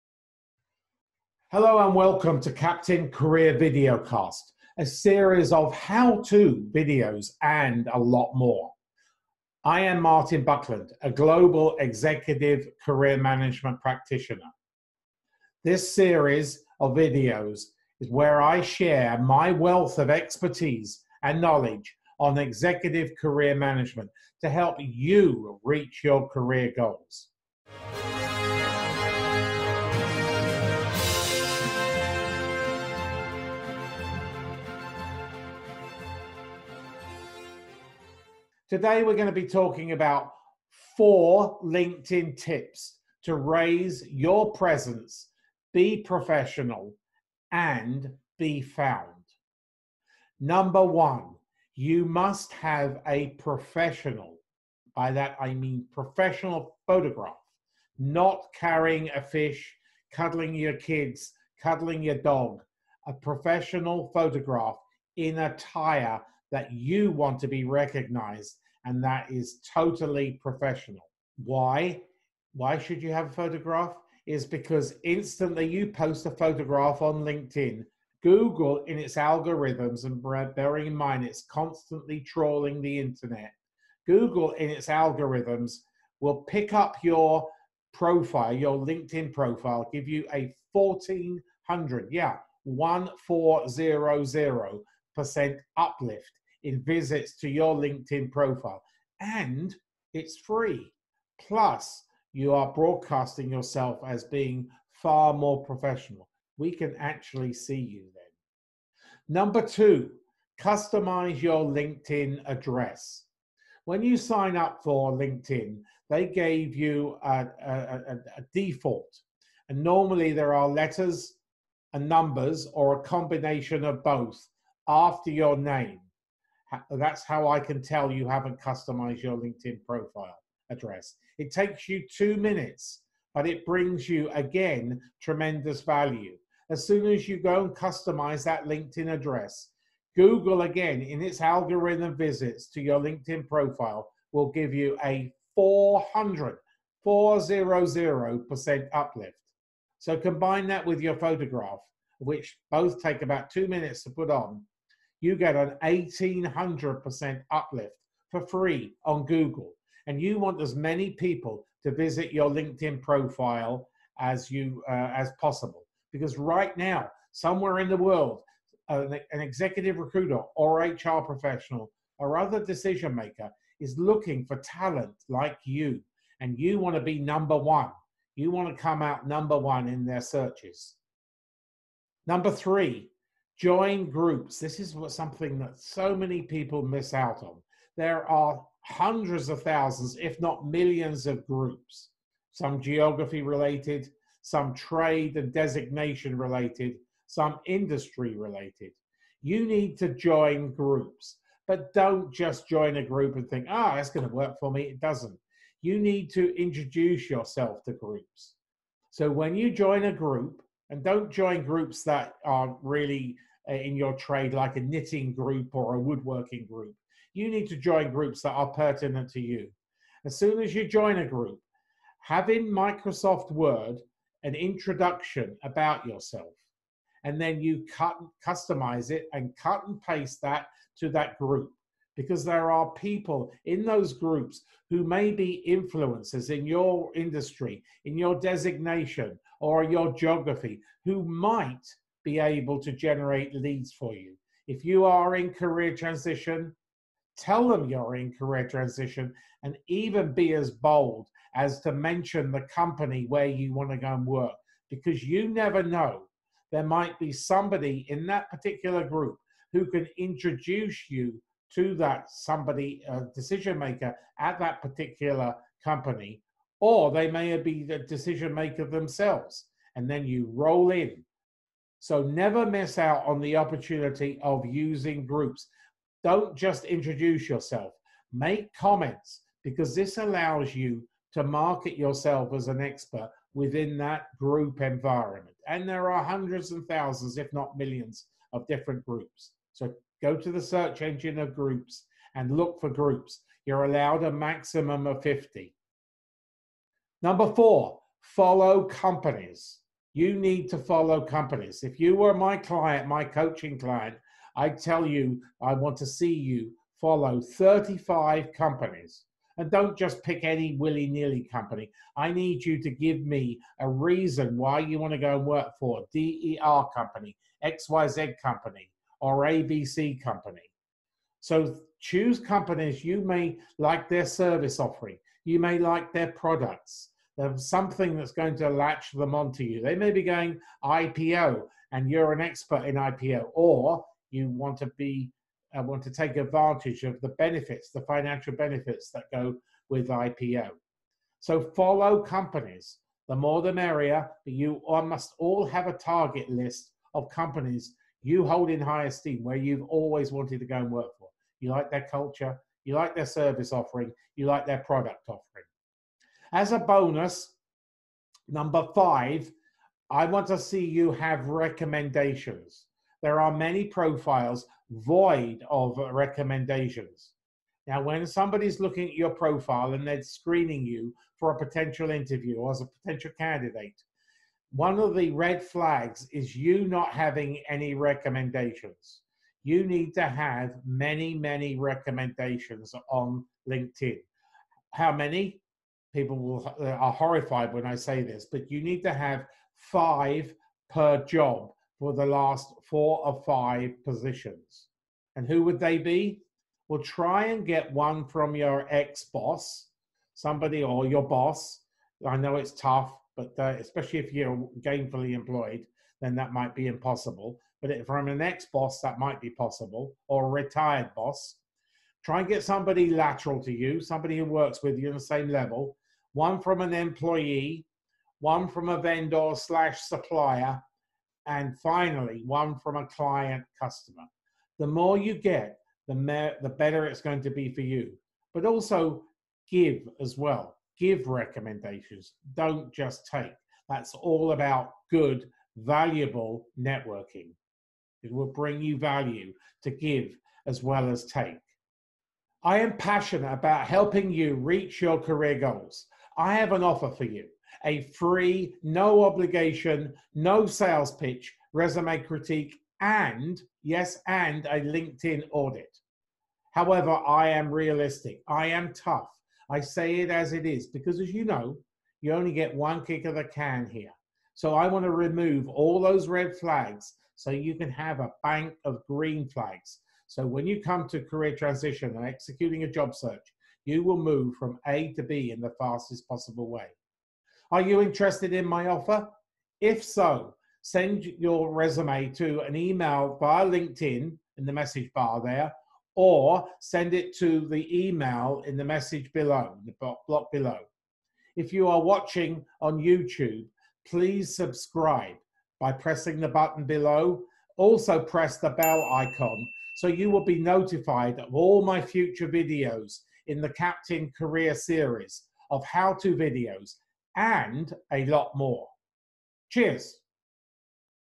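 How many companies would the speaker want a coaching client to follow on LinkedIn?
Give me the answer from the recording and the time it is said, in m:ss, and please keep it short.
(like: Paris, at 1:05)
35, at 5:07.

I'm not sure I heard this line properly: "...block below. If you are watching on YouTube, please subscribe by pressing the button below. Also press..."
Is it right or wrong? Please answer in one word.
right.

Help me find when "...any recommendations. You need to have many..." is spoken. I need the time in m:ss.
6:17.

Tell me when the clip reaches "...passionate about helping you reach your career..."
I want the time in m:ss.
7:22.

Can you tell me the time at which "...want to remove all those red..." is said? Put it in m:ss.
7:44.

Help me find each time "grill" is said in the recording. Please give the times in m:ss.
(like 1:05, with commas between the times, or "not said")
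not said.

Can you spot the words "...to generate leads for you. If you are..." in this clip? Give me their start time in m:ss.
4:02.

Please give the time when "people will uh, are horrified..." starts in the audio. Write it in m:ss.
6:26.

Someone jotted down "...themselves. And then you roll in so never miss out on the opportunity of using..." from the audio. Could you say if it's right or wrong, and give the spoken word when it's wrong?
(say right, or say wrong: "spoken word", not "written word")
right.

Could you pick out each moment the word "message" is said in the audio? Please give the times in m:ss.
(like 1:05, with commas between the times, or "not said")
8:04, 8:08.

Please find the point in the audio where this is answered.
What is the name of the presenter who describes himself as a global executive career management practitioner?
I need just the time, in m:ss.
0:10.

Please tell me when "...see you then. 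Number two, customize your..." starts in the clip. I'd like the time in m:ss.
1:47.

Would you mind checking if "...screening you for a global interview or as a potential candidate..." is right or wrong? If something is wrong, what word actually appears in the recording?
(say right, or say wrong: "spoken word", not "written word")
wrong: "potential", not "global".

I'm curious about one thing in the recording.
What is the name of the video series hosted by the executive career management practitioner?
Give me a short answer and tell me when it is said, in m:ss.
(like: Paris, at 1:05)
Captain Career Videocast, at 0:02.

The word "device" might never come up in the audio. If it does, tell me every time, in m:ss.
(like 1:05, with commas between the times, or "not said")
not said.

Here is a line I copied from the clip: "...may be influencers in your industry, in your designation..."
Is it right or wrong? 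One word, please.
right.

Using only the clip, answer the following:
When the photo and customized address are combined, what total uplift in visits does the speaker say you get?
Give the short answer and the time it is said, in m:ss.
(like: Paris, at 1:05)
1800%, at 2:35.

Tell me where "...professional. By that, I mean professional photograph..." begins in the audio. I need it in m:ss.
0:53.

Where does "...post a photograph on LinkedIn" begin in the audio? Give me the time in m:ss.
1:15.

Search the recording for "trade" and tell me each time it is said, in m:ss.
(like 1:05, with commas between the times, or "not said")
3:14, 3:34.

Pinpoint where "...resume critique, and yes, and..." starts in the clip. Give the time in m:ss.
7:31.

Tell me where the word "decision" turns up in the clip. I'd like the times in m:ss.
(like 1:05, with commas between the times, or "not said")
2:52, 4:23, 4:27.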